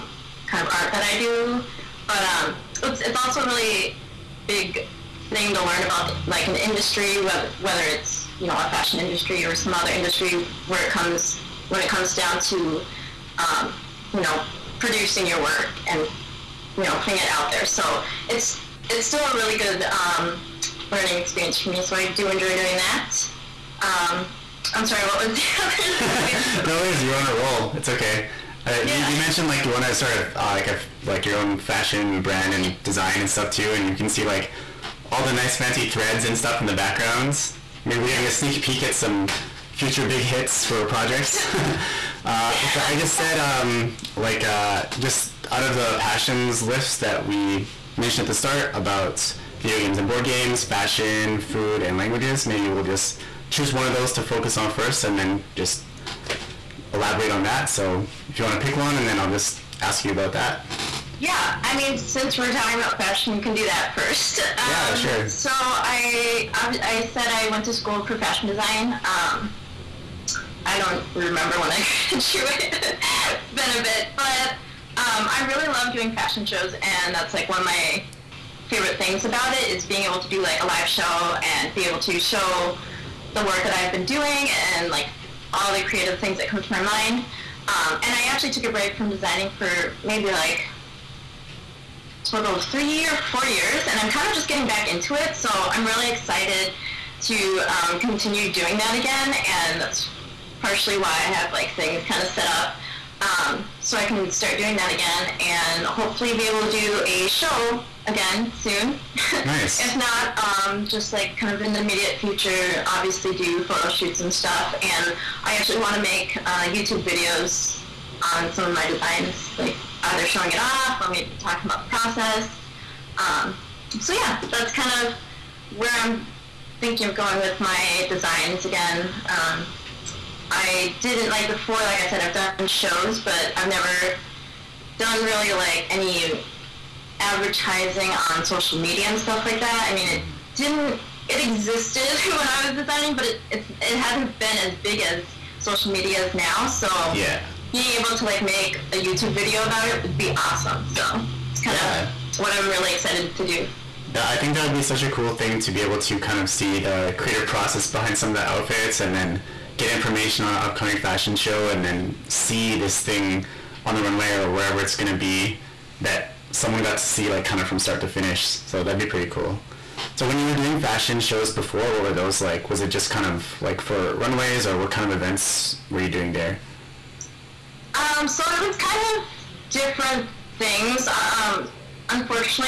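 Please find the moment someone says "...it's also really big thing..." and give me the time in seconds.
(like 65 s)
3 s.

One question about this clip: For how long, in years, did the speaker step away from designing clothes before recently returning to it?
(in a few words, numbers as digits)
3 or 4 years.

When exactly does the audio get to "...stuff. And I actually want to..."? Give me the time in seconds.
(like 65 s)
114 s.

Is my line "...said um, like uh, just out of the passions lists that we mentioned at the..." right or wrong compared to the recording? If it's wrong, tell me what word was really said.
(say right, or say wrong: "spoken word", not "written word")
right.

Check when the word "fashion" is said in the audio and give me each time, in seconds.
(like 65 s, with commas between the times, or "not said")
8 s, 31 s, 50 s, 62 s, 68 s, 76 s, 160 s, 170 s.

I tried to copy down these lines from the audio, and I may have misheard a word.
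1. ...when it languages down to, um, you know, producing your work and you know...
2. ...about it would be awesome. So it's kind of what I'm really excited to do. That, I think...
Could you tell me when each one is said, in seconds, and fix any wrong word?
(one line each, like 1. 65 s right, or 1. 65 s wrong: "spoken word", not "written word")
1. 11 s wrong: "comes", not "languages"
2. 149 s right.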